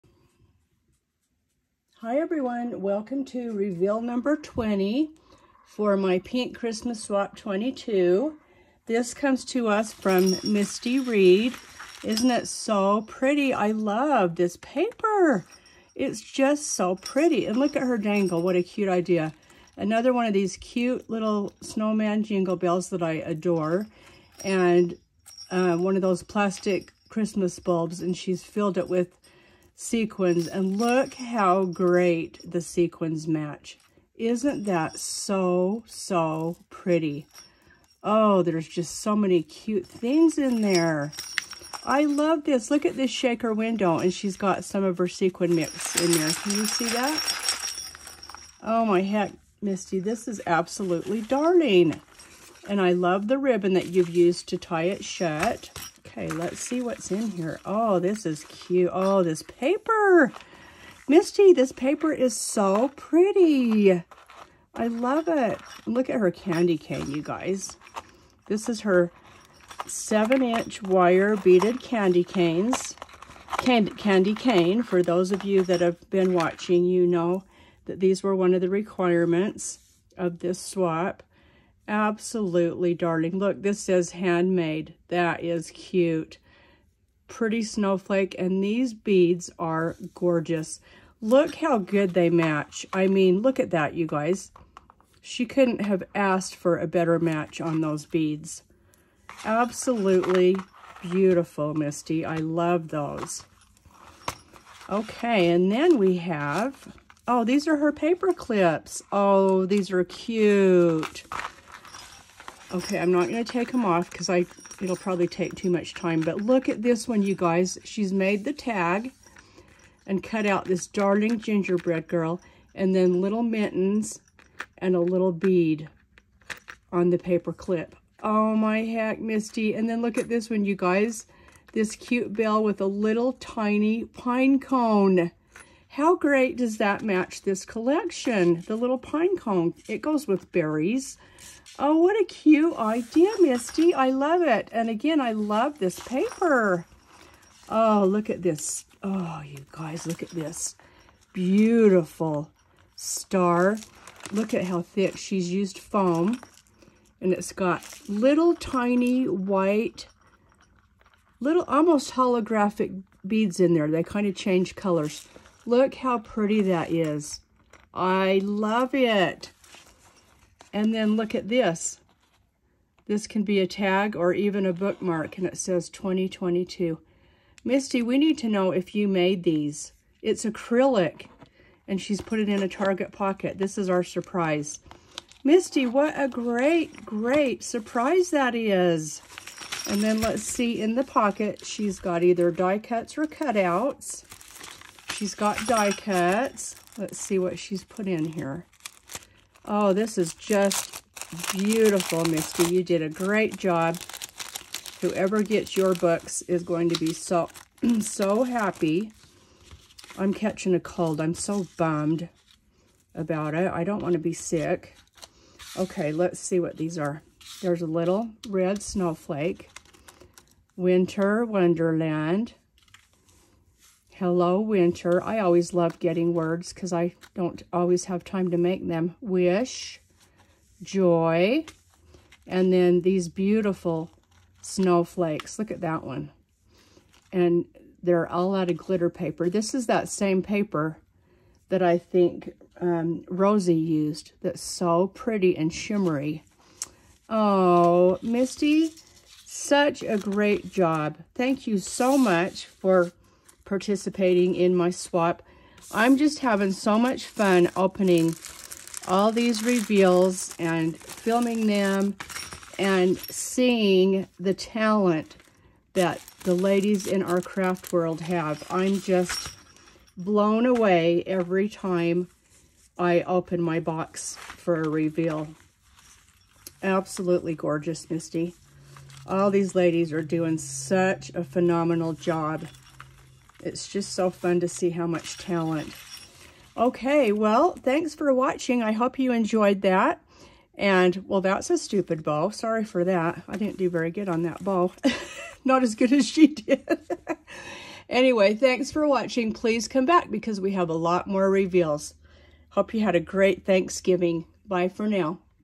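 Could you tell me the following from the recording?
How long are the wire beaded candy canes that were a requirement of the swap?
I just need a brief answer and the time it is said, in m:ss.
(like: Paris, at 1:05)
7-inch, at 1:09.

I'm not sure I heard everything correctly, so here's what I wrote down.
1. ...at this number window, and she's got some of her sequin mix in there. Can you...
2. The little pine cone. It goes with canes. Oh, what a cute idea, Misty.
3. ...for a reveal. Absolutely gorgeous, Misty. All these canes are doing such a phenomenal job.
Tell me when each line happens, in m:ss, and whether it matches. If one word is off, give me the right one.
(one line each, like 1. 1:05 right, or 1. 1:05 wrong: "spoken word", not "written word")
1. 0:42 wrong: "shaker", not "number"
2. 2:18 wrong: "berries", not "canes"
3. 4:34 wrong: "ladies", not "canes".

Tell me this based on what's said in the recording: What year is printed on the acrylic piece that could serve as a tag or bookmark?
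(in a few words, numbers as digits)
2022.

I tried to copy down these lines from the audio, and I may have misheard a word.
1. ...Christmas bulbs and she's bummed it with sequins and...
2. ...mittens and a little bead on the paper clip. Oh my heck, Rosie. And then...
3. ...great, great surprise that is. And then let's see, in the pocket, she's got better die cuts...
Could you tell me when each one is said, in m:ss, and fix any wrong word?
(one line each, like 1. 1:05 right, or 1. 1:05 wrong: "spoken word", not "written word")
1. 0:27 wrong: "filled", not "bummed"
2. 2:03 wrong: "Misty", not "Rosie"
3. 3:06 wrong: "either", not "better".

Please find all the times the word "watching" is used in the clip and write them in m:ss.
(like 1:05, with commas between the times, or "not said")
1:16, 4:48, 4:59.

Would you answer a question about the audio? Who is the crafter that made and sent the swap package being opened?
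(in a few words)
Misty Reed.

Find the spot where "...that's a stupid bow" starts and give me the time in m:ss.
4:51.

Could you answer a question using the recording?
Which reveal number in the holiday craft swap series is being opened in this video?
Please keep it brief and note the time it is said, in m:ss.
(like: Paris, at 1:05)
20, at 0:04.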